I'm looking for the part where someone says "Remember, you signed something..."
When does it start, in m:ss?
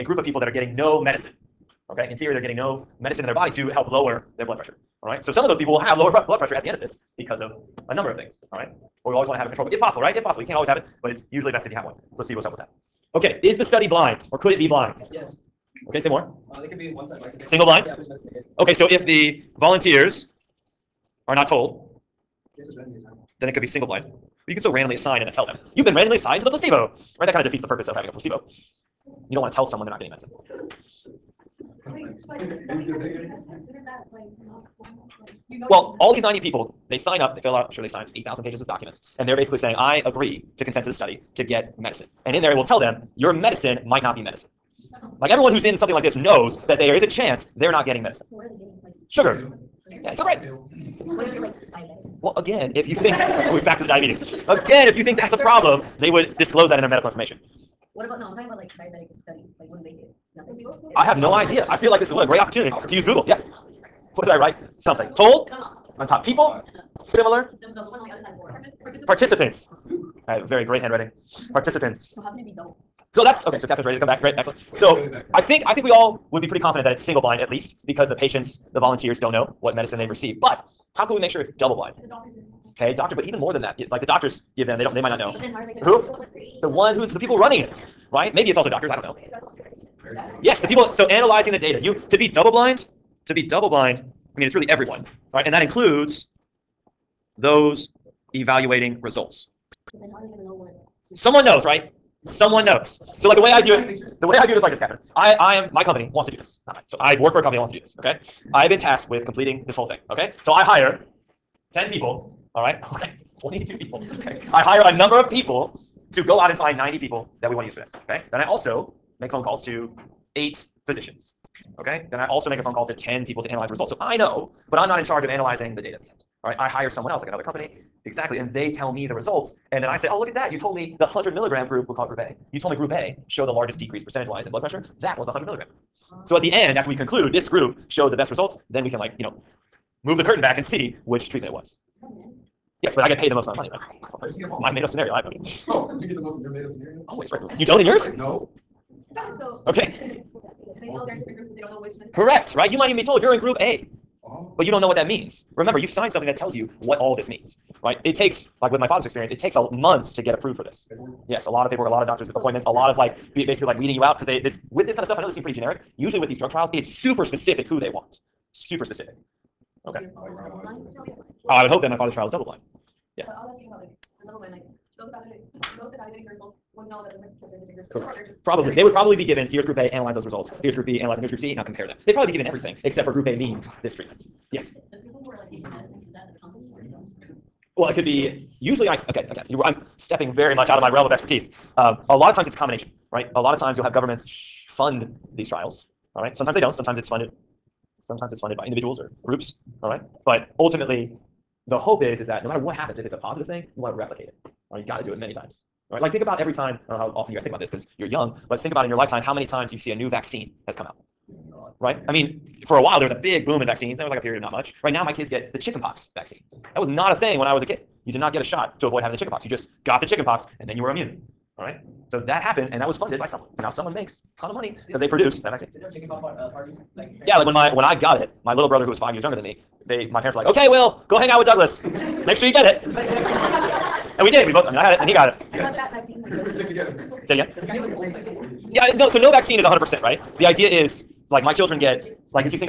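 2:35.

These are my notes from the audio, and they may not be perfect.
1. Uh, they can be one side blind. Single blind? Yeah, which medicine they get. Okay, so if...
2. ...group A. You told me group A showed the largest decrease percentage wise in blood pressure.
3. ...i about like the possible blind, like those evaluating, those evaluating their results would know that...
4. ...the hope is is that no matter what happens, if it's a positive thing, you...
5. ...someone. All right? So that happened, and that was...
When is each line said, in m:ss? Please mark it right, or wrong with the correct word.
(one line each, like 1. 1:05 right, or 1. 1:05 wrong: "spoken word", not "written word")
1. 0:16 right
2. 2:12 right
3. 2:53 wrong: "double", not "possible"
4. 3:21 right
5. 3:40 wrong: "immune", not "someone".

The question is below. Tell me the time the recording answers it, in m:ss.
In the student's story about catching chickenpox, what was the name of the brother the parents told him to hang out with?
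3:51.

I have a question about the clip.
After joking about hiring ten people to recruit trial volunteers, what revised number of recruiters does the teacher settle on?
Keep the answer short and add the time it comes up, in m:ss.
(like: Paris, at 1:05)
22, at 1:53.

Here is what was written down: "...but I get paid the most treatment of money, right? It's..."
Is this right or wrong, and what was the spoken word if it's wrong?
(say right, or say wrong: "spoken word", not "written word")
wrong: "amount", not "treatment".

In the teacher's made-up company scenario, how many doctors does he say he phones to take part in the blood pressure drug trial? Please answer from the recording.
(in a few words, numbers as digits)
8.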